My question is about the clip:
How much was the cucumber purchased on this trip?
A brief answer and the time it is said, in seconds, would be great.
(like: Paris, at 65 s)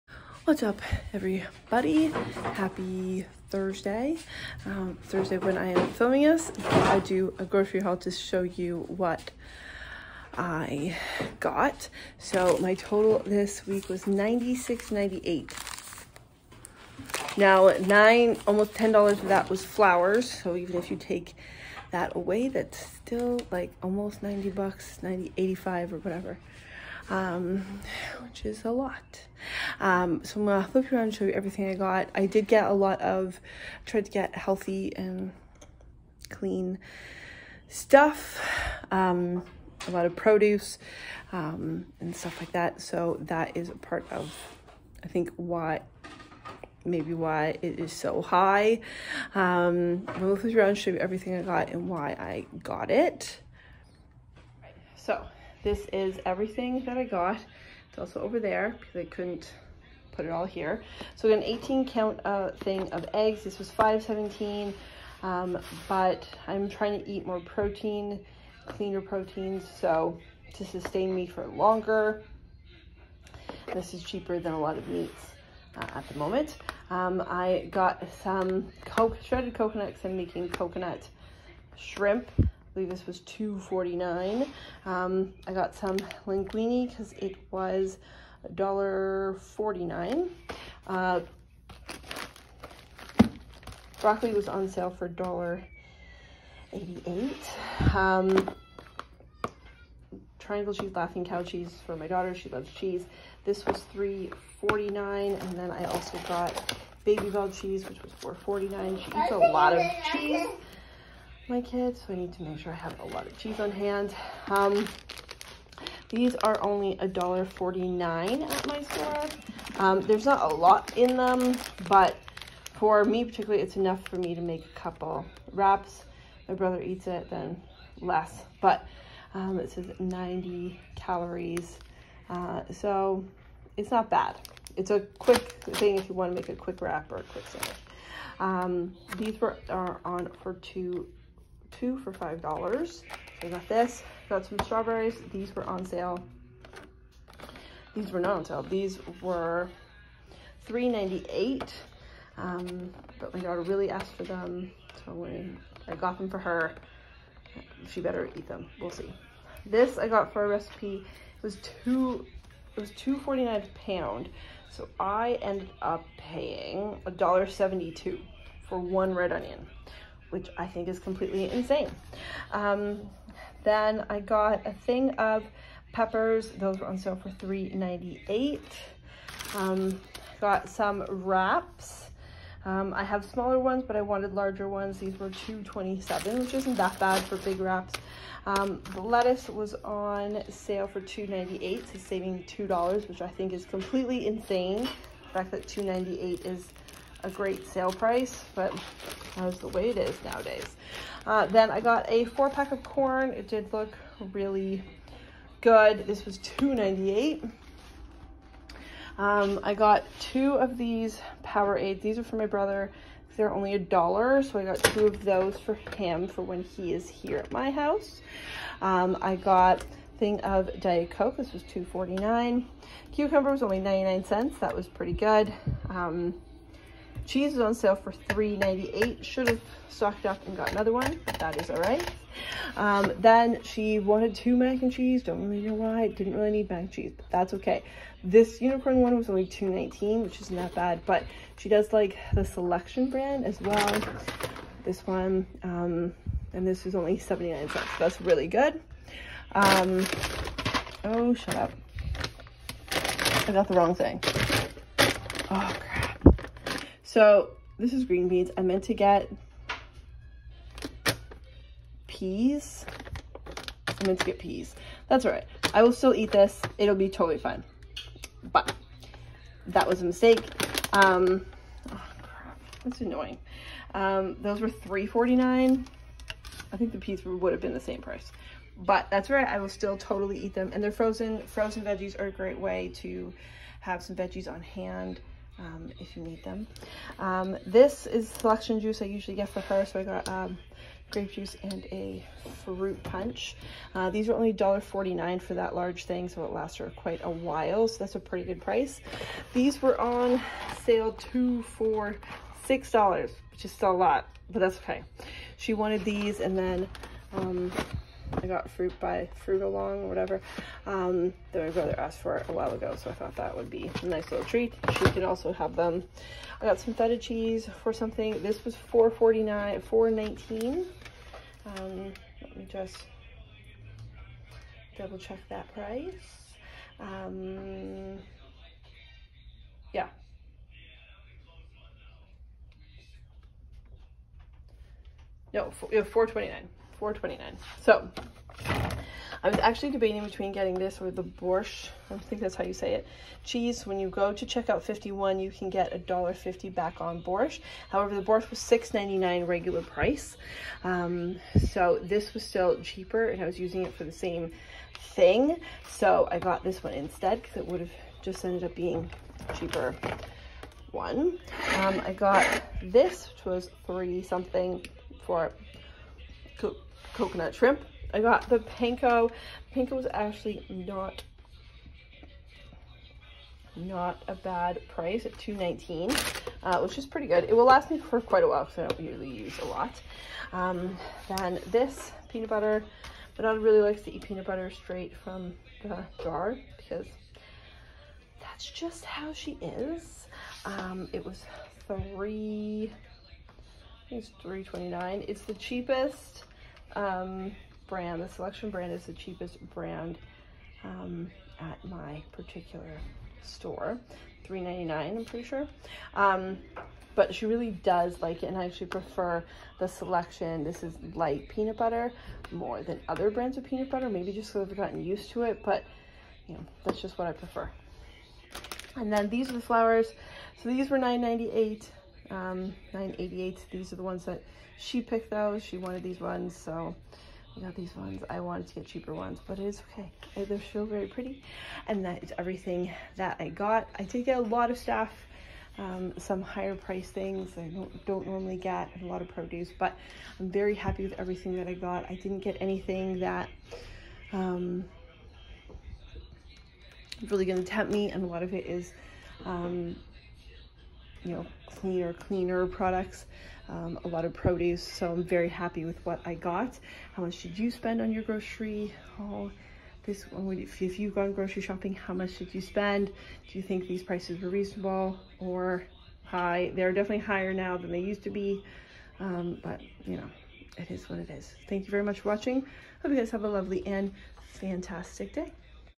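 99 cents, at 223 s.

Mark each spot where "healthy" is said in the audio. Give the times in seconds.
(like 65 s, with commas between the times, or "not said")
34 s.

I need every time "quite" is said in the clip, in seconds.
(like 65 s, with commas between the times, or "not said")
296 s, 378 s.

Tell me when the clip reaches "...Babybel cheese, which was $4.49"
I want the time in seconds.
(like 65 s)
107 s.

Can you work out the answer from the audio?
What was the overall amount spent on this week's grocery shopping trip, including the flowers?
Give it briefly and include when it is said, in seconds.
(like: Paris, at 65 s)
$96.98, at 14 s.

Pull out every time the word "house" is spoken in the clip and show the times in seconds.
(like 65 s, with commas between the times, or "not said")
217 s.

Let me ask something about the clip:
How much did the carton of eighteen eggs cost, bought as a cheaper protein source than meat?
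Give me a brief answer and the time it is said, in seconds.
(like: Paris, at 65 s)
$5.17, at 63 s.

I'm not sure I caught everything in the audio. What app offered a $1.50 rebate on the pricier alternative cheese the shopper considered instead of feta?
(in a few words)
Checkout 51.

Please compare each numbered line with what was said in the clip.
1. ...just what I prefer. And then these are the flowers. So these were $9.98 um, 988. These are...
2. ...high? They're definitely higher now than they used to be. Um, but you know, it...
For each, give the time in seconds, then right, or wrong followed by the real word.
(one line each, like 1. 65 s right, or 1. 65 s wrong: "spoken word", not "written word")
1. 417 s right
2. 466 s right.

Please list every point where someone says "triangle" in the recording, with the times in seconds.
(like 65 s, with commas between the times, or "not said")
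100 s.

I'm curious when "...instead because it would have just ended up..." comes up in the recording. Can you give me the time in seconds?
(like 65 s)
356 s.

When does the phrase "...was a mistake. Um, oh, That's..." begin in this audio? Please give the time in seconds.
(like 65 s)
269 s.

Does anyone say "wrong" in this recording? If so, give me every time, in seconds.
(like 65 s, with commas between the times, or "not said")
253 s.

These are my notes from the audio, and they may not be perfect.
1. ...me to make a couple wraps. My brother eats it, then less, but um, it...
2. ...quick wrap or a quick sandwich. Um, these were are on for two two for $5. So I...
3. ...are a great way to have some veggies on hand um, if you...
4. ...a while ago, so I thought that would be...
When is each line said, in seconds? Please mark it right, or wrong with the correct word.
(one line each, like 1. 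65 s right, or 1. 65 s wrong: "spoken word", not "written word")
1. 124 s right
2. 136 s right
3. 282 s right
4. 312 s right.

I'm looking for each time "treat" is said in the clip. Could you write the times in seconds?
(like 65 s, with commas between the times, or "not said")
314 s.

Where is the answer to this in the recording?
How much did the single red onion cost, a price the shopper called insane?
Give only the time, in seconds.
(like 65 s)
167 s.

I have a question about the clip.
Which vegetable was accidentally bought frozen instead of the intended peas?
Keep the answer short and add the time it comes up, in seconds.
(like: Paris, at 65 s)
green beans, at 258 s.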